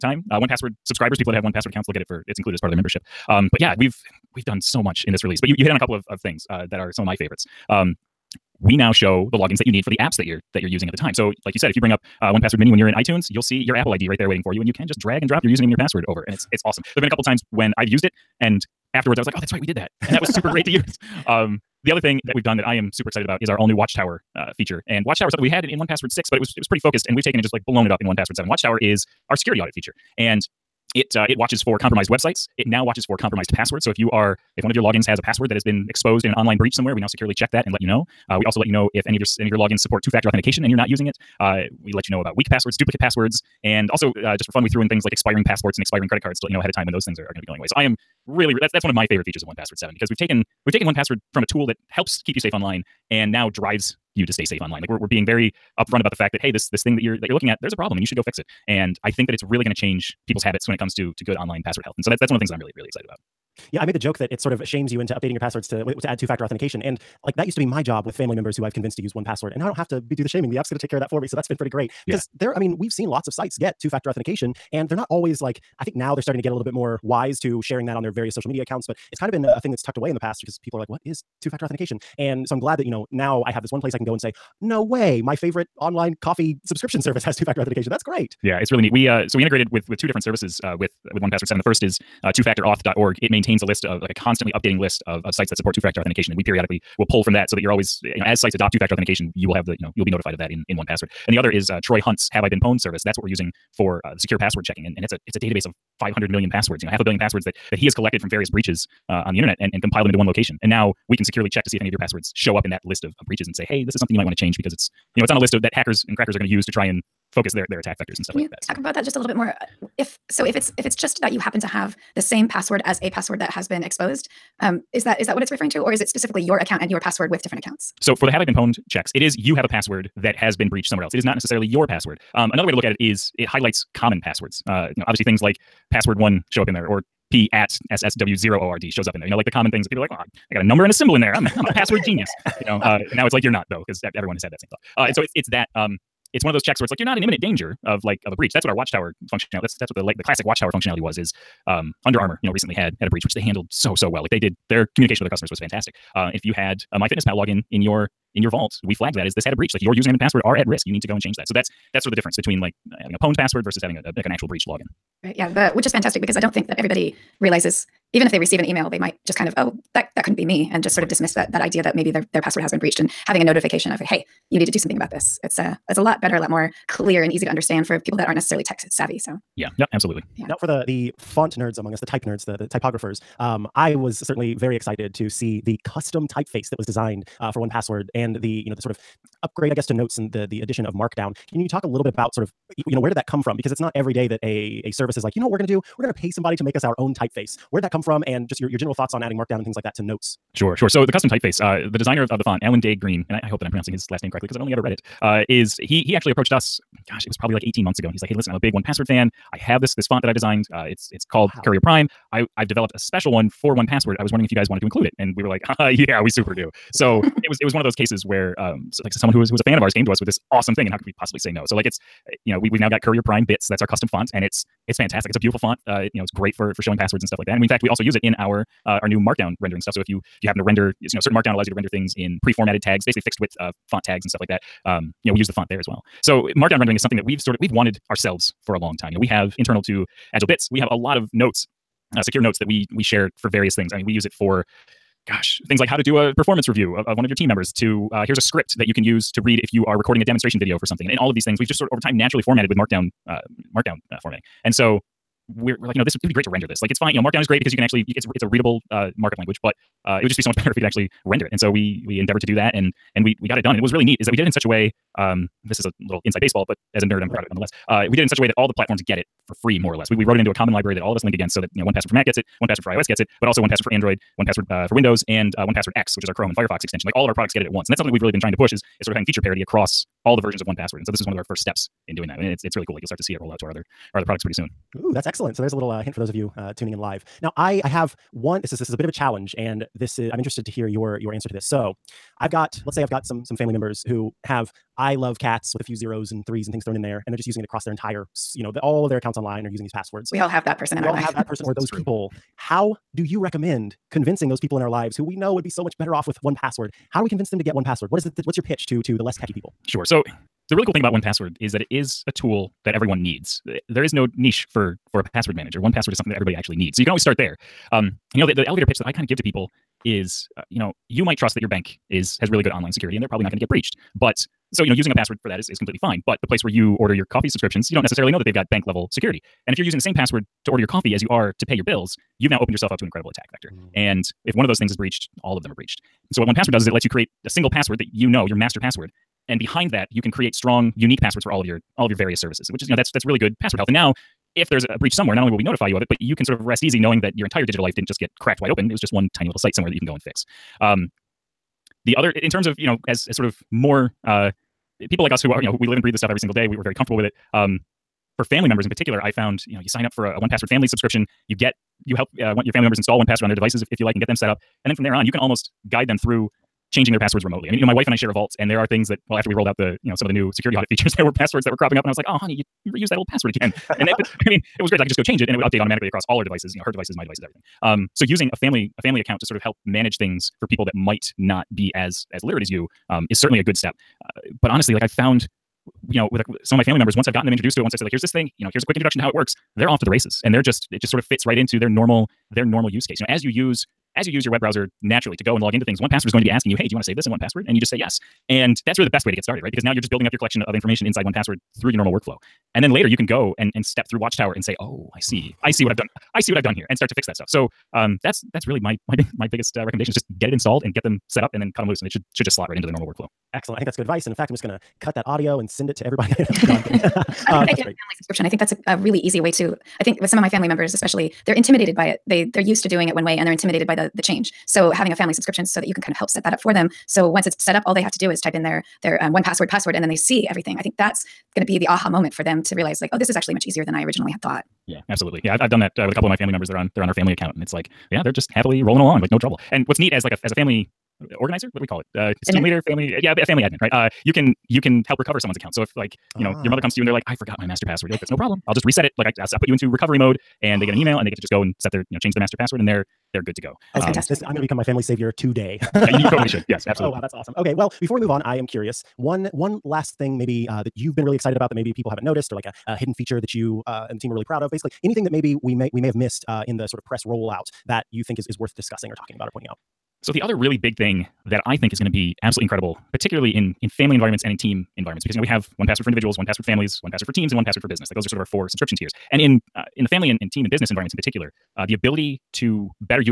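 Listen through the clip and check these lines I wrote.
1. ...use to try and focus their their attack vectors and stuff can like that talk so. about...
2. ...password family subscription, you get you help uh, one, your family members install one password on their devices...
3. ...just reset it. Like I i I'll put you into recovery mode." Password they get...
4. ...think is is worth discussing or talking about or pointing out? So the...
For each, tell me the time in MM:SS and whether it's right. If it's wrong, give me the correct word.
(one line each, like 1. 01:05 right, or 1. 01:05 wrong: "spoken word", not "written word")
1. 01:56 right
2. 06:00 right
3. 07:28 wrong: "And", not "Password"
4. 07:48 right.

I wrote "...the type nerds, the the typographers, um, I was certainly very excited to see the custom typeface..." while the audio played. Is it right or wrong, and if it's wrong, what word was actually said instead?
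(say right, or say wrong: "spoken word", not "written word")
right.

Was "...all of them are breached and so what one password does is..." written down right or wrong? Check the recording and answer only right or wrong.
right.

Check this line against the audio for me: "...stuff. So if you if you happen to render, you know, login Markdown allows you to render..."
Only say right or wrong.
wrong.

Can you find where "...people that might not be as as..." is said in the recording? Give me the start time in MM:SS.
06:20.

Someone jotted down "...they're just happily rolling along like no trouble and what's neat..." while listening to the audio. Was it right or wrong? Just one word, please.
right.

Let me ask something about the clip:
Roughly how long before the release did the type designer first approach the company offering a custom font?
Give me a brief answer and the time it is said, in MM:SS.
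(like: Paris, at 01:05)
18 months, at 03:27.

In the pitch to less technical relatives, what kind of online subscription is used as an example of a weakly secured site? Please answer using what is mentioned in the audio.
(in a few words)
Coffee subscriptions.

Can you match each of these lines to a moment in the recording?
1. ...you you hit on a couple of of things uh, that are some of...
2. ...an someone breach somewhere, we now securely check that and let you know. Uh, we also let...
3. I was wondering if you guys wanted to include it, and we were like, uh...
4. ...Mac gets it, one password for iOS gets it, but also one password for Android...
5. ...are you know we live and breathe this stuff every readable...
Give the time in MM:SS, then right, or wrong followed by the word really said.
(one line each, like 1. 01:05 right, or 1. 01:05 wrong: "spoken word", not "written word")
1. 00:05 right
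2. 00:36 wrong: "online", not "someone"
3. 03:34 right
4. 04:32 right
5. 05:55 wrong: "single", not "readable".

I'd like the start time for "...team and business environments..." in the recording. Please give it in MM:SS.
08:00.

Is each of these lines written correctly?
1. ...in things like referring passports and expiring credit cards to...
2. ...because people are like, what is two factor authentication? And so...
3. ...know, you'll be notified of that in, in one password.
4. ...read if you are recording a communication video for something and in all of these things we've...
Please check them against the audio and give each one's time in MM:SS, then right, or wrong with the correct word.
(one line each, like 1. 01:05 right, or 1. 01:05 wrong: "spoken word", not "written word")
1. 00:44 wrong: "expiring", not "referring"
2. 01:20 right
3. 01:39 right
4. 04:09 wrong: "demonstration", not "communication".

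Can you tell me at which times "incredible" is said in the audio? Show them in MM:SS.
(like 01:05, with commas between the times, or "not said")
05:33, 07:52.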